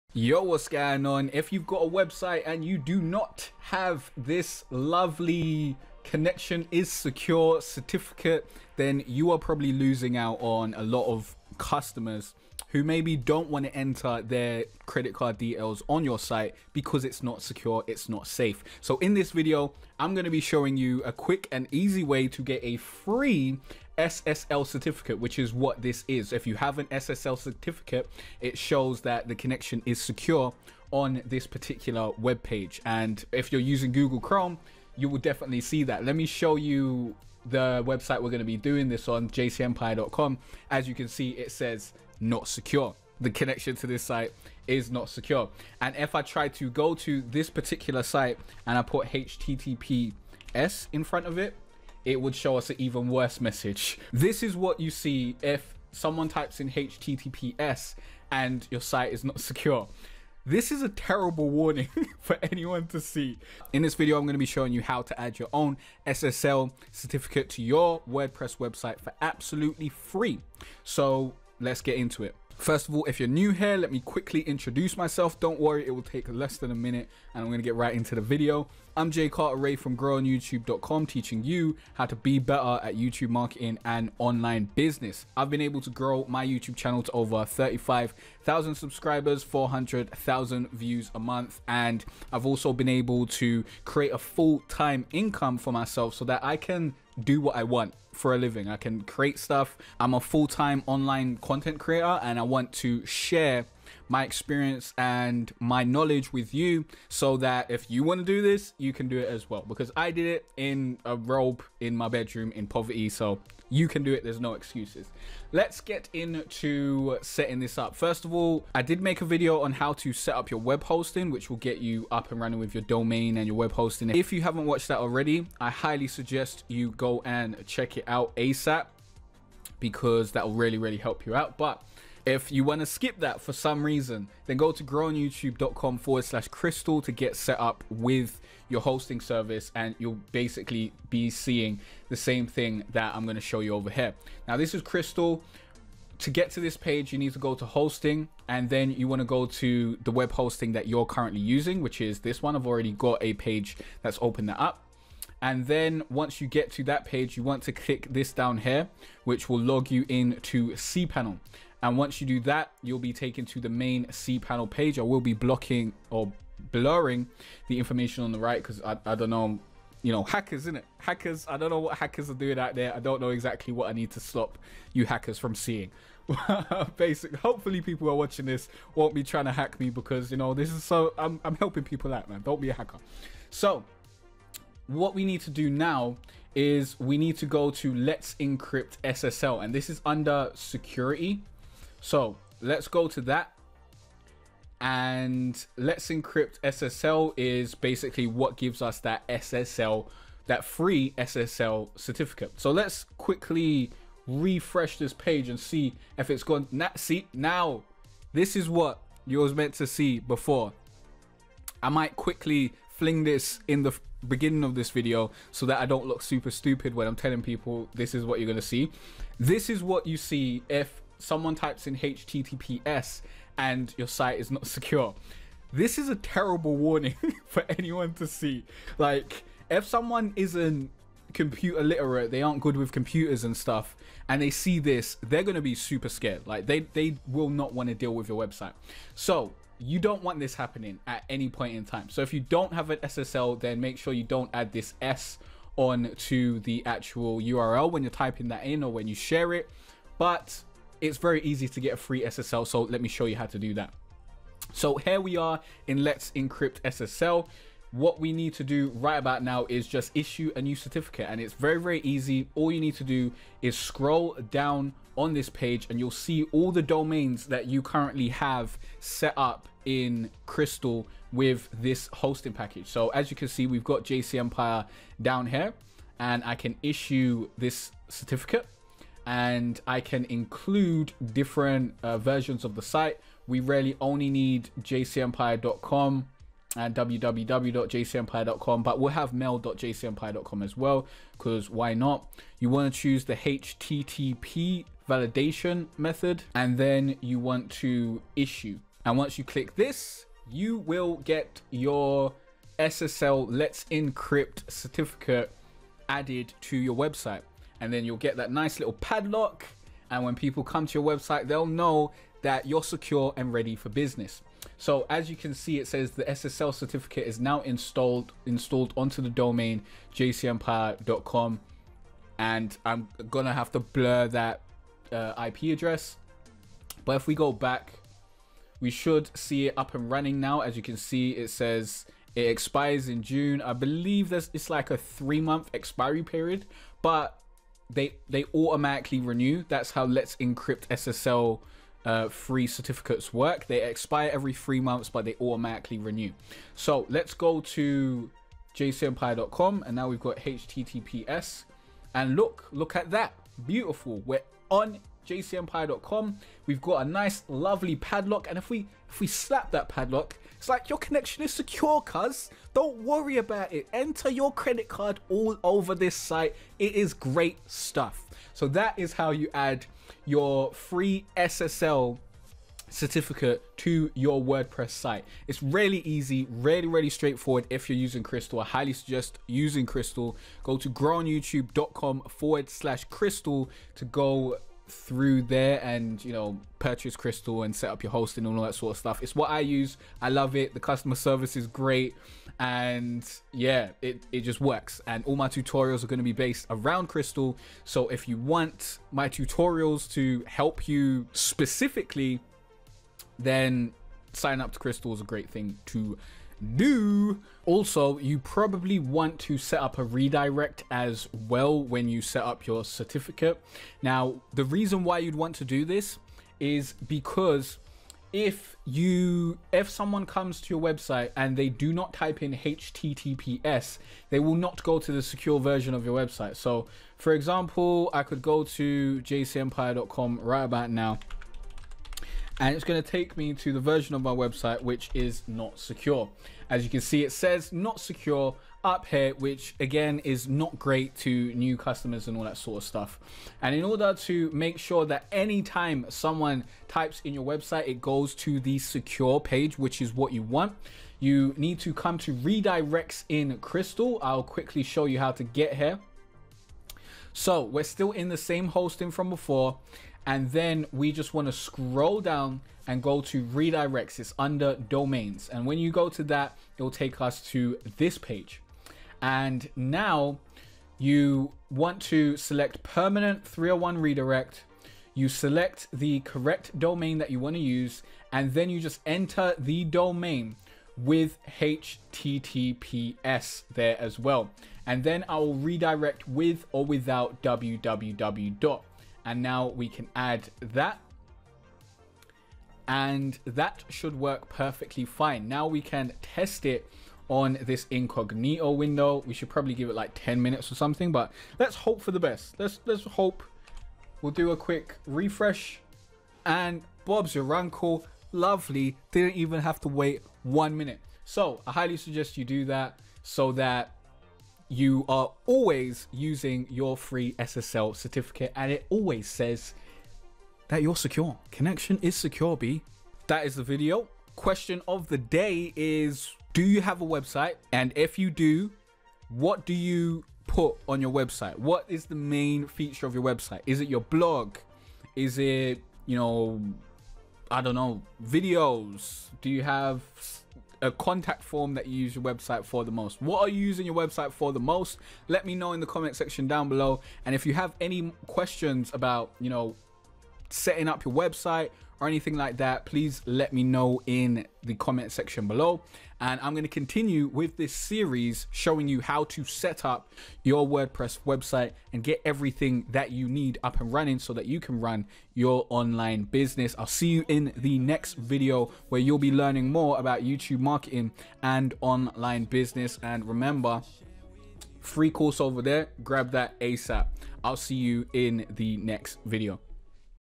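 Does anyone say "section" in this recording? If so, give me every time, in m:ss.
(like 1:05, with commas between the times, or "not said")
9:06, 9:15.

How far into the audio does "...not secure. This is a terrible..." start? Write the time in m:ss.
0:59.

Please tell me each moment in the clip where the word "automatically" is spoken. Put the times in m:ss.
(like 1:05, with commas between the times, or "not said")
5:38, 5:45.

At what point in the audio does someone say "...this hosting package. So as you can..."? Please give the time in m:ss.
4:31.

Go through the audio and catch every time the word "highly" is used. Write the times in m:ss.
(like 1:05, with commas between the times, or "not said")
2:05, 6:18, 8:31.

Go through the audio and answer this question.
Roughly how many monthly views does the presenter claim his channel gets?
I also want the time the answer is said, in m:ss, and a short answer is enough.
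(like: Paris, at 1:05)
400,000, at 1:29.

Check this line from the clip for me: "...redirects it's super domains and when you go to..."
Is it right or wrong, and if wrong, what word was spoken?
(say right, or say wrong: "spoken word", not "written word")
wrong: "under", not "super".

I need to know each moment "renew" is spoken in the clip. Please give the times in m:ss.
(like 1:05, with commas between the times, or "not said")
5:39, 5:45.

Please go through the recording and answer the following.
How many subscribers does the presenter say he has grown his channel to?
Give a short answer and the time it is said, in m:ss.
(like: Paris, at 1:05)
35,000, at 1:27.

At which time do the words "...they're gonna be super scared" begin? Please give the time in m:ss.
3:55.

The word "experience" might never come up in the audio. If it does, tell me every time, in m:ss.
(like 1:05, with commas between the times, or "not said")
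1:44.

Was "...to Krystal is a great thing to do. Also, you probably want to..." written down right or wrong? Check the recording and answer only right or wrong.
right.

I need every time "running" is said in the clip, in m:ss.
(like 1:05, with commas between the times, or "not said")
2:02, 5:30, 9:23.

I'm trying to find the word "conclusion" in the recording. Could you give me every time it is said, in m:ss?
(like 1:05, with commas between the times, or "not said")
not said.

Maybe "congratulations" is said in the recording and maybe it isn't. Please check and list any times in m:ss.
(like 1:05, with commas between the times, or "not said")
not said.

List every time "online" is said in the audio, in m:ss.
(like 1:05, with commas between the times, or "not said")
1:24, 1:40, 9:25, 9:31.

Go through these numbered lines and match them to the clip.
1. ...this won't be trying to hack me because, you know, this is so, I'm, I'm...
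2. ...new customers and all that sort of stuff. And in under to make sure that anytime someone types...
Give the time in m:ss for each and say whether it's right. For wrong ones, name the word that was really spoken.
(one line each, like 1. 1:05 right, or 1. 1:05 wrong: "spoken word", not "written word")
1. 2:58 right
2. 7:21 wrong: "order", not "under".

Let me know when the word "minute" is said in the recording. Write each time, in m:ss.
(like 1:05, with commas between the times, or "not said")
1:16, 8:20, 8:30.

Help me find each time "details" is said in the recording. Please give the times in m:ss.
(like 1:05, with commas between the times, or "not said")
0:15.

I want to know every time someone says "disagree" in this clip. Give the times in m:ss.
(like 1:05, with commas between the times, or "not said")
not said.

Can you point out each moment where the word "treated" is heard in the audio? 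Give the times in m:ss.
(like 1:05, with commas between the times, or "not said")
not said.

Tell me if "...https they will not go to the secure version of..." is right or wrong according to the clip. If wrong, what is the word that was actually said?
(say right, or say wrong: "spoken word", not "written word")
right.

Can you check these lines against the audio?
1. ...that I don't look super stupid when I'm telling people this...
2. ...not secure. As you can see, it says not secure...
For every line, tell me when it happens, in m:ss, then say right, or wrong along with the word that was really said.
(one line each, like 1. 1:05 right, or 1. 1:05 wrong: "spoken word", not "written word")
1. 3:35 right
2. 7:15 right.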